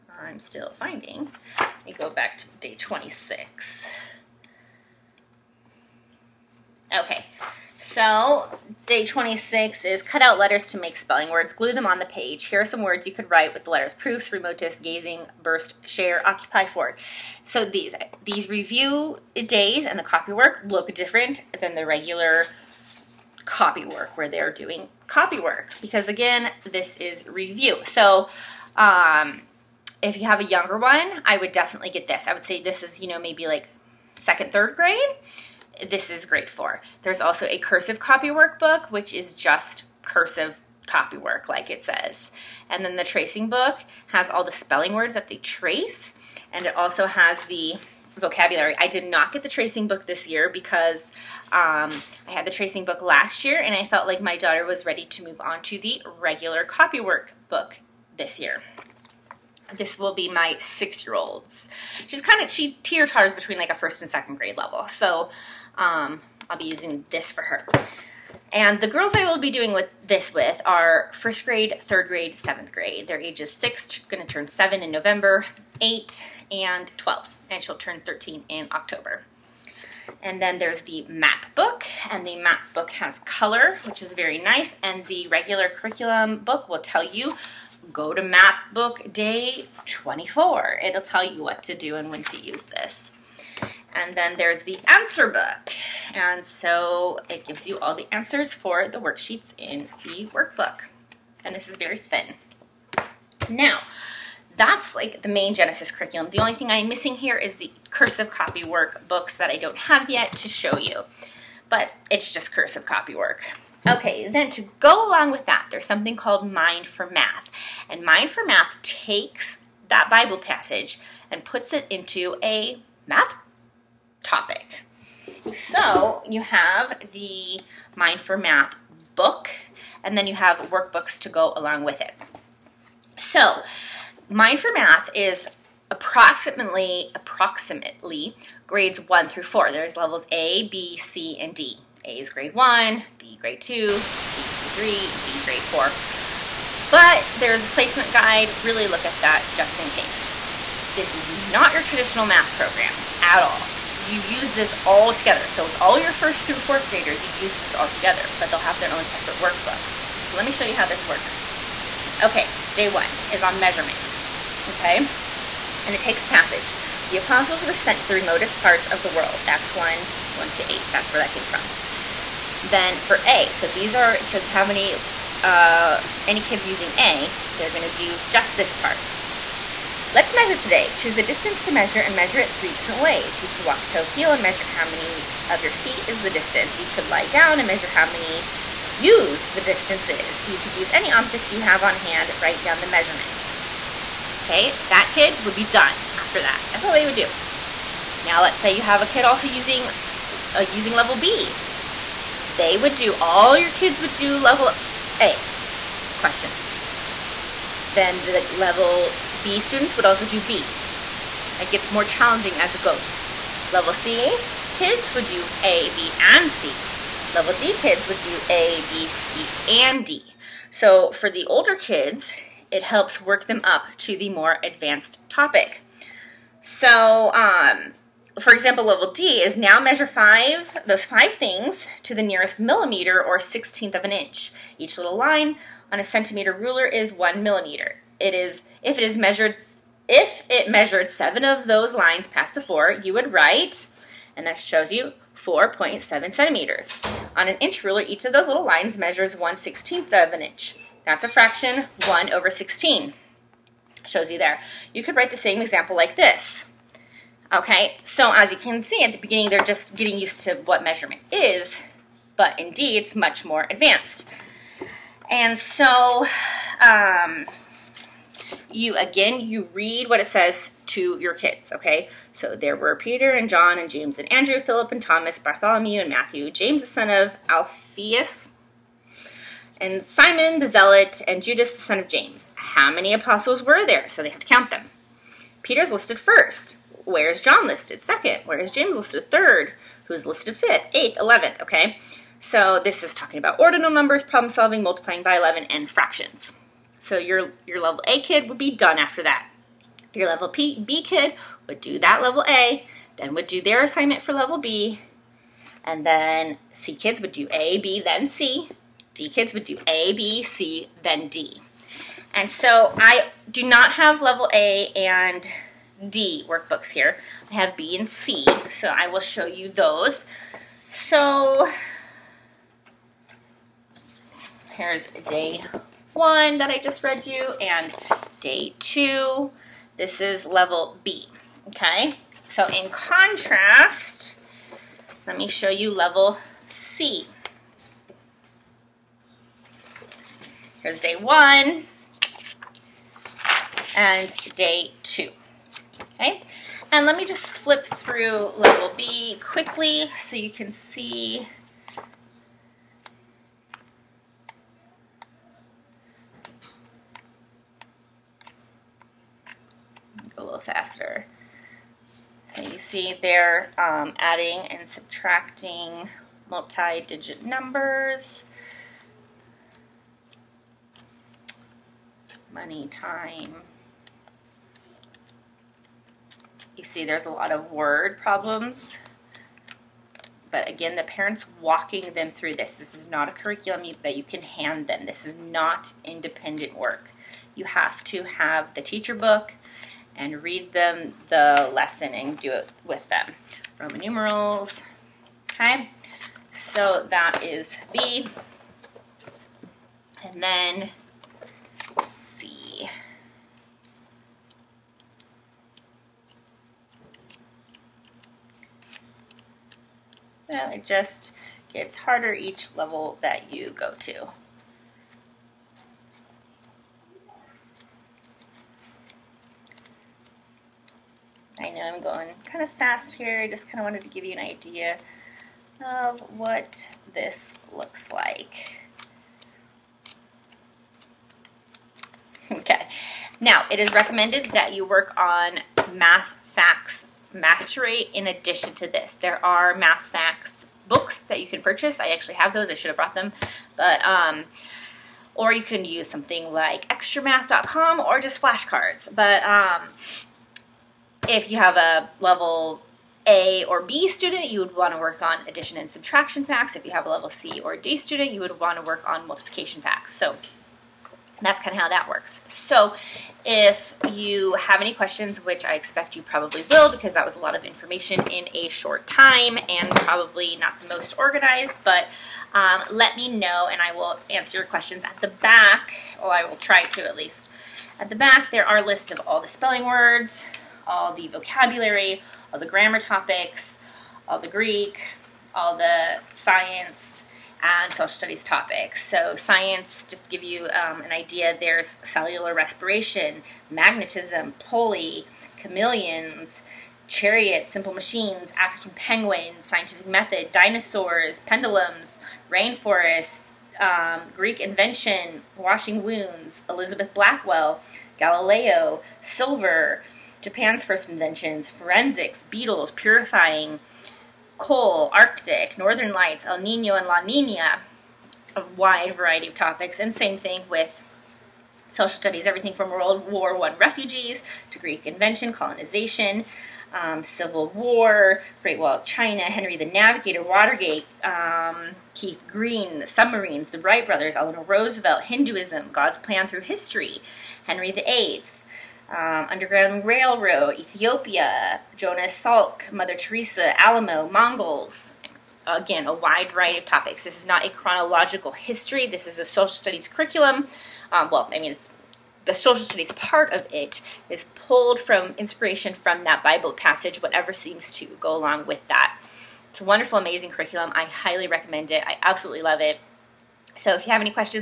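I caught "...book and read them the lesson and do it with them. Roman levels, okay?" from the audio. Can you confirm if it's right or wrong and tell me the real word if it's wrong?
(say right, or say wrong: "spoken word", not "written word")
wrong: "numerals", not "levels".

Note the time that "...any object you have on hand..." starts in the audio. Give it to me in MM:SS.
03:10.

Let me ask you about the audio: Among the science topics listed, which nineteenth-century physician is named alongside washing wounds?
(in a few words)
Elizabeth Blackwell.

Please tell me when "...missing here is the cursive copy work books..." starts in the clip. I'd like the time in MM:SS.
01:46.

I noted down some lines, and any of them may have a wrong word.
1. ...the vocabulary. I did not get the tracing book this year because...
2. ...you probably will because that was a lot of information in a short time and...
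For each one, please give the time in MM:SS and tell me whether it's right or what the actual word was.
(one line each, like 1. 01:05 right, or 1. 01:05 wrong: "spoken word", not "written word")
1. 00:47 right
2. 07:46 right.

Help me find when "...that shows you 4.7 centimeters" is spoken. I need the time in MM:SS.
04:04.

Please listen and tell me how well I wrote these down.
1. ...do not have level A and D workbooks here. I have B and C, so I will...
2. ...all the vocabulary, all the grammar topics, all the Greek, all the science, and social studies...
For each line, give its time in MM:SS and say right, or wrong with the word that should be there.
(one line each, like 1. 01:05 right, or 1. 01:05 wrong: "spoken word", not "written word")
1. 05:13 right
2. 08:00 right.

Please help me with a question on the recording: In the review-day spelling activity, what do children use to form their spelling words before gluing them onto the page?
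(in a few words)
Cut out letters.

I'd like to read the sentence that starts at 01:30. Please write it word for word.
It'll tell you what to do and when to use this.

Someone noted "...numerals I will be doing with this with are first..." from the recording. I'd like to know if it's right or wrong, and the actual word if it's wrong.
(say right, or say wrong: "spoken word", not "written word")
wrong: "girls", not "numerals".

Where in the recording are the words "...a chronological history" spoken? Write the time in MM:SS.
09:07.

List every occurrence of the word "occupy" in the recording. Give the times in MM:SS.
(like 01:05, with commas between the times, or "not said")
00:16.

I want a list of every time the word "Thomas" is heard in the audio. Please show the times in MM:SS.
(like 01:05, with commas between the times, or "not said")
04:35.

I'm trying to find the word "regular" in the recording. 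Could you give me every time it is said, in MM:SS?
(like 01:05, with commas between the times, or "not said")
00:21, 00:56, 01:25.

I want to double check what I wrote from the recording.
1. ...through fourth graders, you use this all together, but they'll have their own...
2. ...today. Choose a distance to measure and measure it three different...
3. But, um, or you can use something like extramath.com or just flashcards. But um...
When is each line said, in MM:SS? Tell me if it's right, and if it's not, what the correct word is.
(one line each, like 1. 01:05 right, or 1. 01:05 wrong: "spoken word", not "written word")
1. 02:36 right
2. 03:00 right
3. 07:23 right.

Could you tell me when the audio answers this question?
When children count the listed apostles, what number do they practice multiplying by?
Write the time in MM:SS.
04:55.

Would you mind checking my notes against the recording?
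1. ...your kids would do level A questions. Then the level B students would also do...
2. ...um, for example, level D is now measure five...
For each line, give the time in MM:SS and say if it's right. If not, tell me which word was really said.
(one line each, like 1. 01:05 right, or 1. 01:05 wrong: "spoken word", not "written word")
1. 03:23 right
2. 03:47 right.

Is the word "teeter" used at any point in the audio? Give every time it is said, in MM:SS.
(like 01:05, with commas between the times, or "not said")
01:02.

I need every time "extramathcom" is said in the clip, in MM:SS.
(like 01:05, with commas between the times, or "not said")
07:26.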